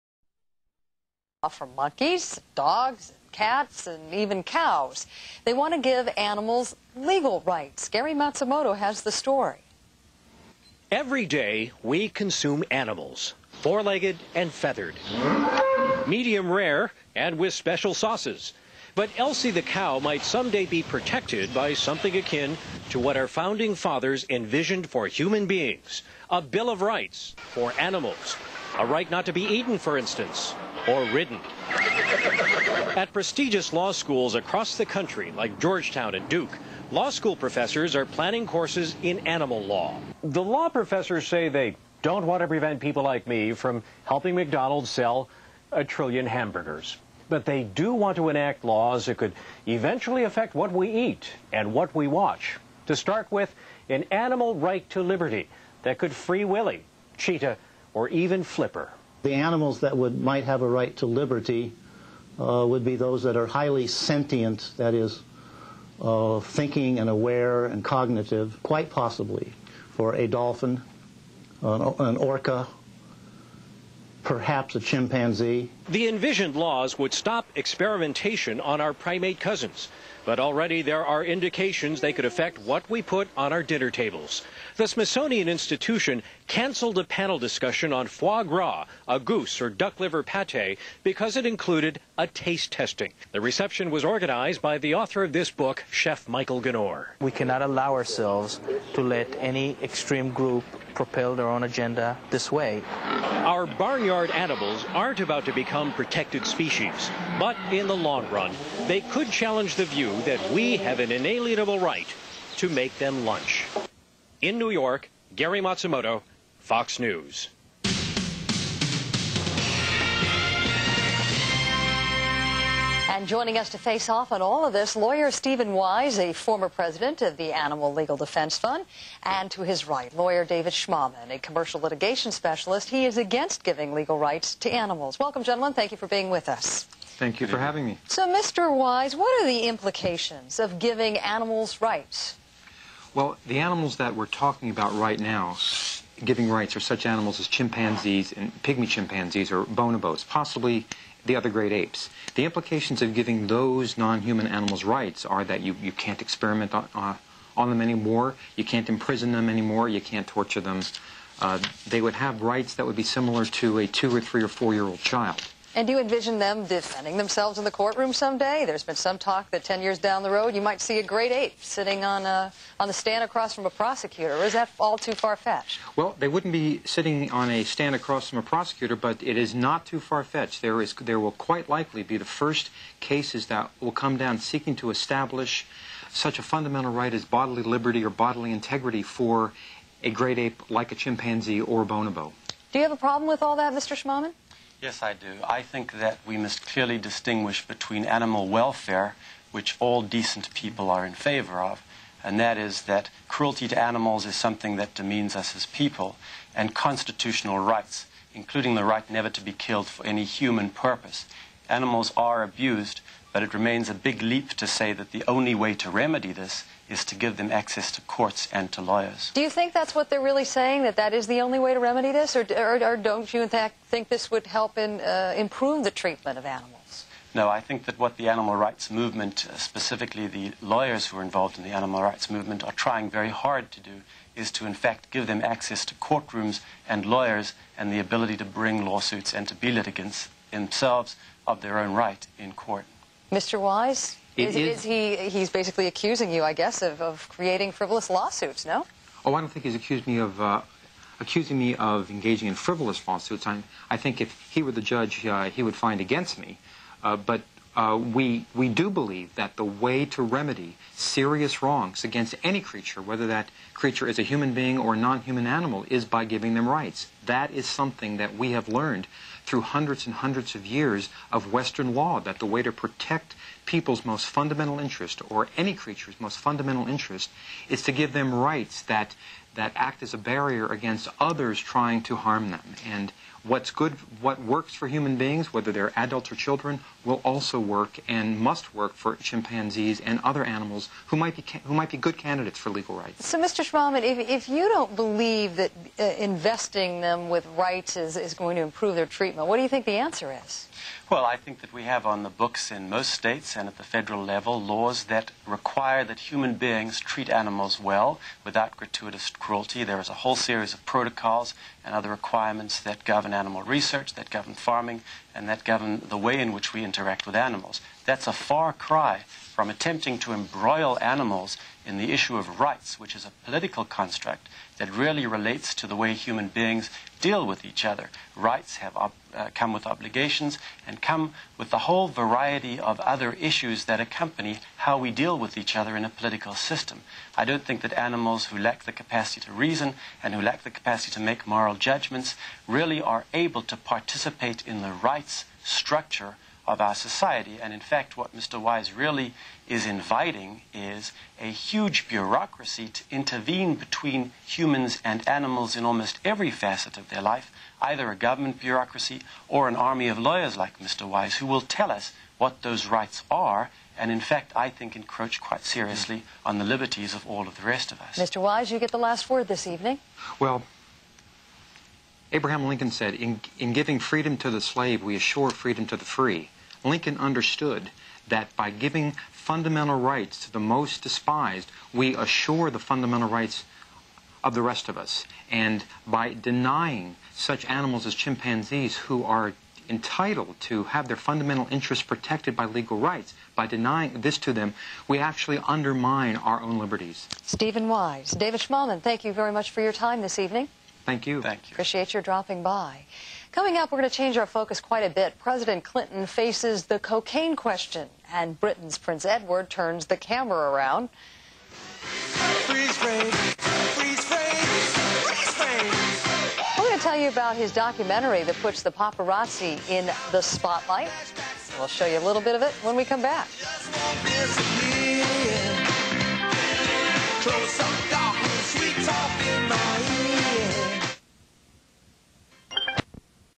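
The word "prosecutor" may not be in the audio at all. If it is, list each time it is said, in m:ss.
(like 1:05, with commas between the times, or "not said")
2:53, 2:58.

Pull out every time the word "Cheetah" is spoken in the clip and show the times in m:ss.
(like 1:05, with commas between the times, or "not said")
0:57.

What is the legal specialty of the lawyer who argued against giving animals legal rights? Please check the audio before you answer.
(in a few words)
commercial litigation.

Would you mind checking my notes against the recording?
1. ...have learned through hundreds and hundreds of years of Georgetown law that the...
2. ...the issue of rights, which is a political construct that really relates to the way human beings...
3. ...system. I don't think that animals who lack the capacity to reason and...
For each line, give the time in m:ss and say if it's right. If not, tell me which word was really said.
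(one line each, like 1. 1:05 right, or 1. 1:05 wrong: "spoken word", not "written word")
1. 4:28 wrong: "Western", not "Georgetown"
2. 5:21 right
3. 5:36 right.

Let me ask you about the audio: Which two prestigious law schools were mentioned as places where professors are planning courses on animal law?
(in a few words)
Georgetown and Duke.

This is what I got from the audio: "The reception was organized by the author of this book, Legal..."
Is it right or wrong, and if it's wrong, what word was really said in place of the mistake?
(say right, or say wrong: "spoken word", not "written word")
wrong: "Chef", not "Legal".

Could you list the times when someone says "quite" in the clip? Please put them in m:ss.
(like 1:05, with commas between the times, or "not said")
1:08, 3:01, 6:05, 6:44.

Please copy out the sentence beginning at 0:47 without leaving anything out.
But they do want to enact laws that could eventually affect what we eat and what we watch.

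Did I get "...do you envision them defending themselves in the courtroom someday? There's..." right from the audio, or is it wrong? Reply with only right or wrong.
right.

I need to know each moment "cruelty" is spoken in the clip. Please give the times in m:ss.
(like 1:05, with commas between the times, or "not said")
3:23, 5:09.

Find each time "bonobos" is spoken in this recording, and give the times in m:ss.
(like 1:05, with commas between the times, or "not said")
2:29, 3:11.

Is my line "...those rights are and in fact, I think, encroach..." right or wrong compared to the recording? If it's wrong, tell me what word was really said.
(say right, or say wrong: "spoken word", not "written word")
right.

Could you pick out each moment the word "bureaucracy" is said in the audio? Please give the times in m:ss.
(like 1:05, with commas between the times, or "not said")
5:52, 5:58.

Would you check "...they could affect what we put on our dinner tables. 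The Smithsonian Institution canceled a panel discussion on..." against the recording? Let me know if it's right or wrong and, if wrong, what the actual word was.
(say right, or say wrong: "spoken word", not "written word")
right.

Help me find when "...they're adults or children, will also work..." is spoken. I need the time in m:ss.
4:45.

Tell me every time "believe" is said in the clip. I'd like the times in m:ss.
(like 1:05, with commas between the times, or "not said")
4:18, 4:54.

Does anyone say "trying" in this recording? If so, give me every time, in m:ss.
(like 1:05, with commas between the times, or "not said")
3:52, 4:41.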